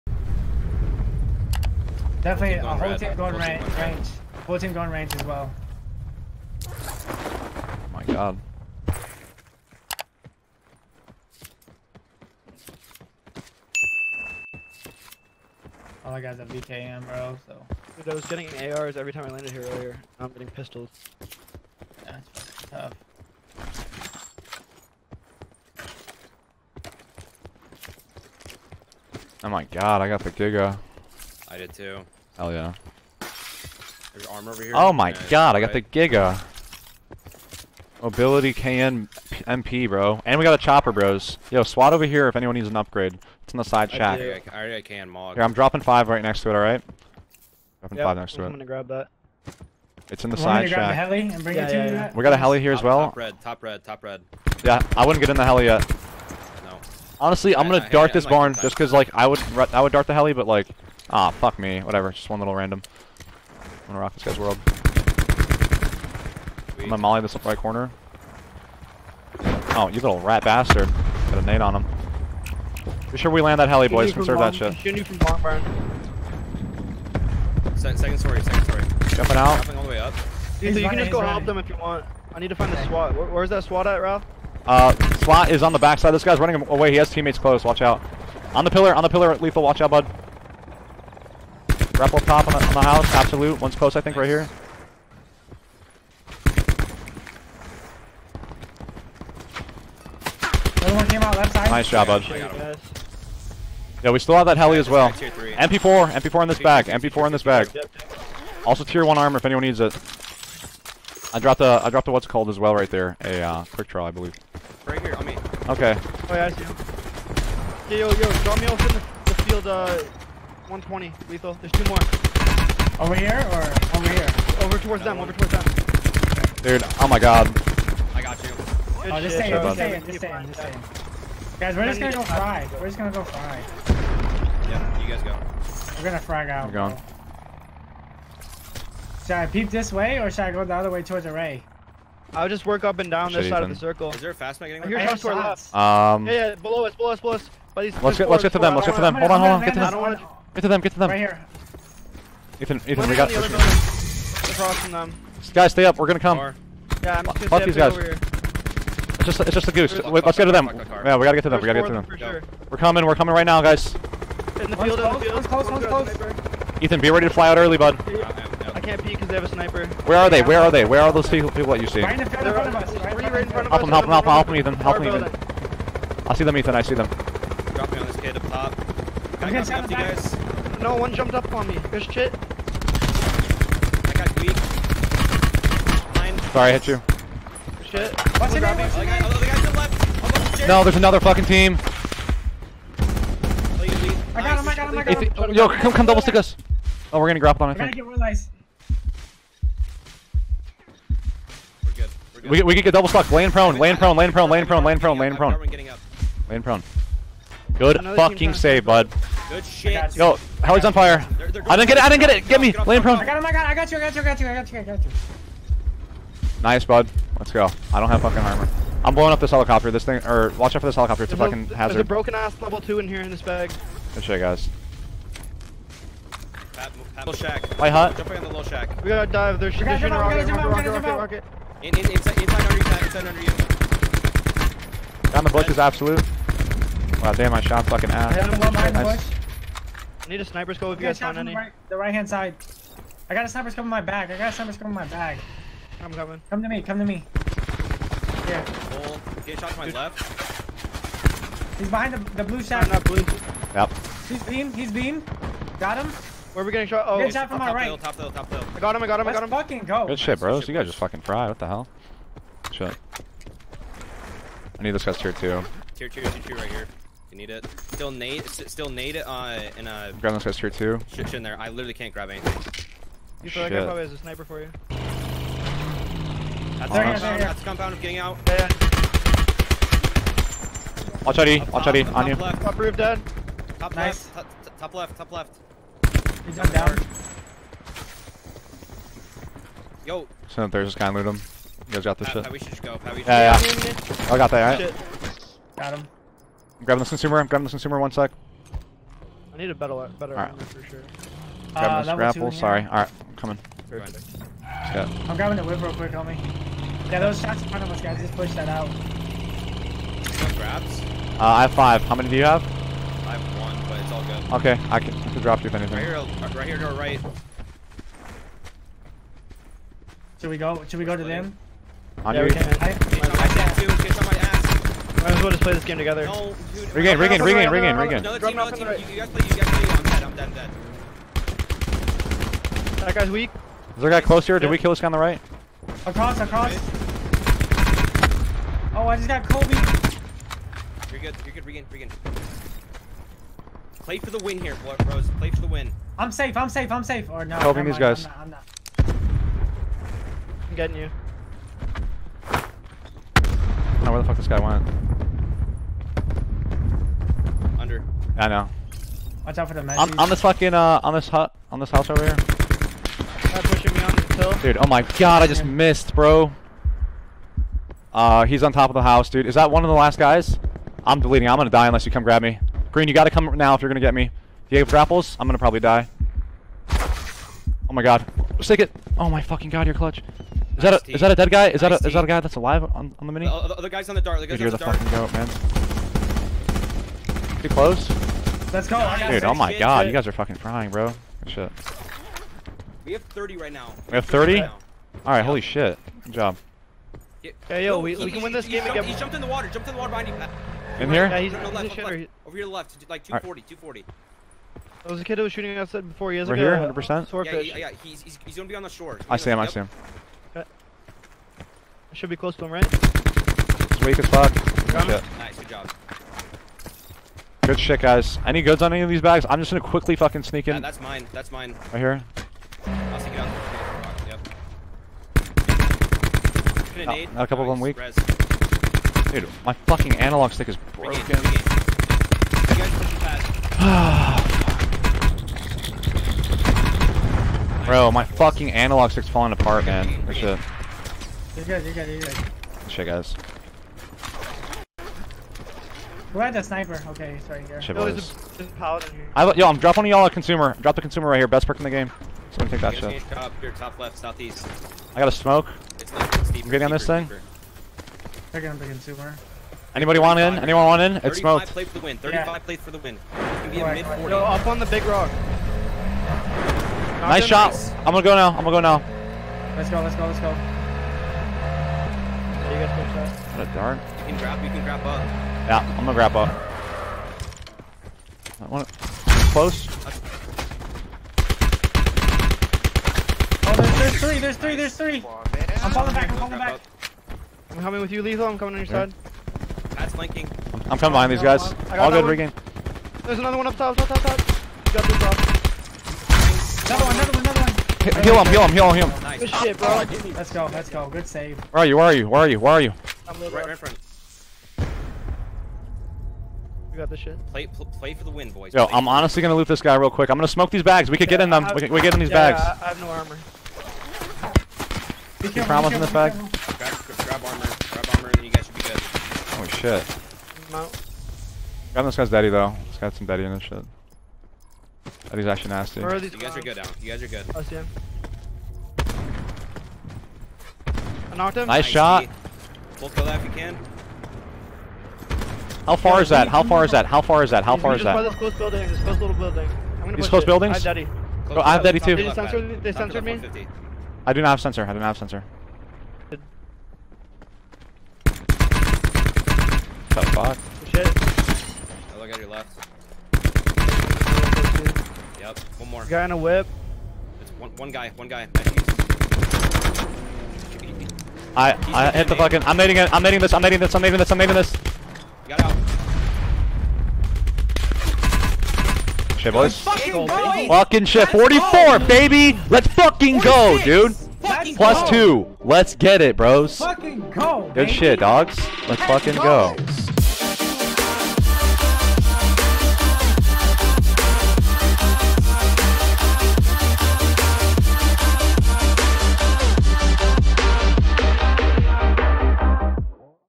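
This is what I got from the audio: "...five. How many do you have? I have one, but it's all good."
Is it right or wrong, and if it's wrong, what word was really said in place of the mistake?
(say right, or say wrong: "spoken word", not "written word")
right.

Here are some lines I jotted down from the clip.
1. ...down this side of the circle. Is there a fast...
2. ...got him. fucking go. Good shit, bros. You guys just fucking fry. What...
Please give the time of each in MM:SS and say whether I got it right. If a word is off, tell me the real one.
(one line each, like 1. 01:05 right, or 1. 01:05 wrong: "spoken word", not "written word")
1. 02:23 right
2. 04:19 right.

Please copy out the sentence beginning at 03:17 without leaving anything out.
Oh, we're gonna grab on it.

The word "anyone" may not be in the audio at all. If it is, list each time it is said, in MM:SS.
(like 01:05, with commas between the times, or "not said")
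00:42, 01:49, 07:40.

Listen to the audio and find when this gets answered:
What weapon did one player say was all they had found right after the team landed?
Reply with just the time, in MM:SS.
00:16.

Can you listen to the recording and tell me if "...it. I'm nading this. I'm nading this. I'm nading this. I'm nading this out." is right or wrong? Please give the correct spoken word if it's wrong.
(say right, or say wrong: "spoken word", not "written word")
right.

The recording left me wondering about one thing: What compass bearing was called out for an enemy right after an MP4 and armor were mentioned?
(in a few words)
120.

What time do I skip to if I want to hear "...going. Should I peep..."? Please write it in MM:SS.
02:16.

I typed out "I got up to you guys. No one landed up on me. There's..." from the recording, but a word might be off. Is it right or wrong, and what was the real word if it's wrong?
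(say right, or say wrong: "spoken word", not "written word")
wrong: "jumped", not "landed".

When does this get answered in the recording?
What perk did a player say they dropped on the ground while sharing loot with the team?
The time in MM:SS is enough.
01:53.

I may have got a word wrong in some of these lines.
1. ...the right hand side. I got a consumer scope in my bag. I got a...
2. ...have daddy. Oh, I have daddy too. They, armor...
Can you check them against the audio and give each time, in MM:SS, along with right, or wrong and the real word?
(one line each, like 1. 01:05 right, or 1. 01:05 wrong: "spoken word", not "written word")
1. 04:01 wrong: "sniper", not "consumer"
2. 09:00 wrong: "censor", not "armor".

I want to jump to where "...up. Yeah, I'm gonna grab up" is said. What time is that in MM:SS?
07:55.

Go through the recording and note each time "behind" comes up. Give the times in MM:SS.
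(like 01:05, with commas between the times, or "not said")
03:58, 04:11, 06:40, 08:11.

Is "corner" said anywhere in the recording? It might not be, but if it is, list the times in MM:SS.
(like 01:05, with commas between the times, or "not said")
01:07.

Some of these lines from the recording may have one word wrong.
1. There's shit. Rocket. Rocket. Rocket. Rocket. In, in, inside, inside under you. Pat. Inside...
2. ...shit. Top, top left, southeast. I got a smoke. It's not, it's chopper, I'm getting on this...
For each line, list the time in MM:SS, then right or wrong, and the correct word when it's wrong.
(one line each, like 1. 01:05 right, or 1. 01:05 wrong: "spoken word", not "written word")
1. 03:49 right
2. 07:32 wrong: "deeper", not "chopper".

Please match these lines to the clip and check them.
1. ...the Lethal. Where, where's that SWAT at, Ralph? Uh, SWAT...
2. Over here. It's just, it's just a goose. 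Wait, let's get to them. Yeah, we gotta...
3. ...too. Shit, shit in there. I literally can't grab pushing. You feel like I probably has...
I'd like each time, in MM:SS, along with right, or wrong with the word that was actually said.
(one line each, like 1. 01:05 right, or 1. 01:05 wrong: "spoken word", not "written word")
1. 01:22 wrong: "SWAT", not "Lethal"
2. 02:37 right
3. 04:30 wrong: "anything", not "pushing".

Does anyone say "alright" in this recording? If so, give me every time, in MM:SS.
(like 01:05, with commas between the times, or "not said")
00:46, 06:35.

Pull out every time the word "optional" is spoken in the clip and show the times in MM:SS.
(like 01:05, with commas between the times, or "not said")
not said.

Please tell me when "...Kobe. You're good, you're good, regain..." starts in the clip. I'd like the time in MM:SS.
05:39.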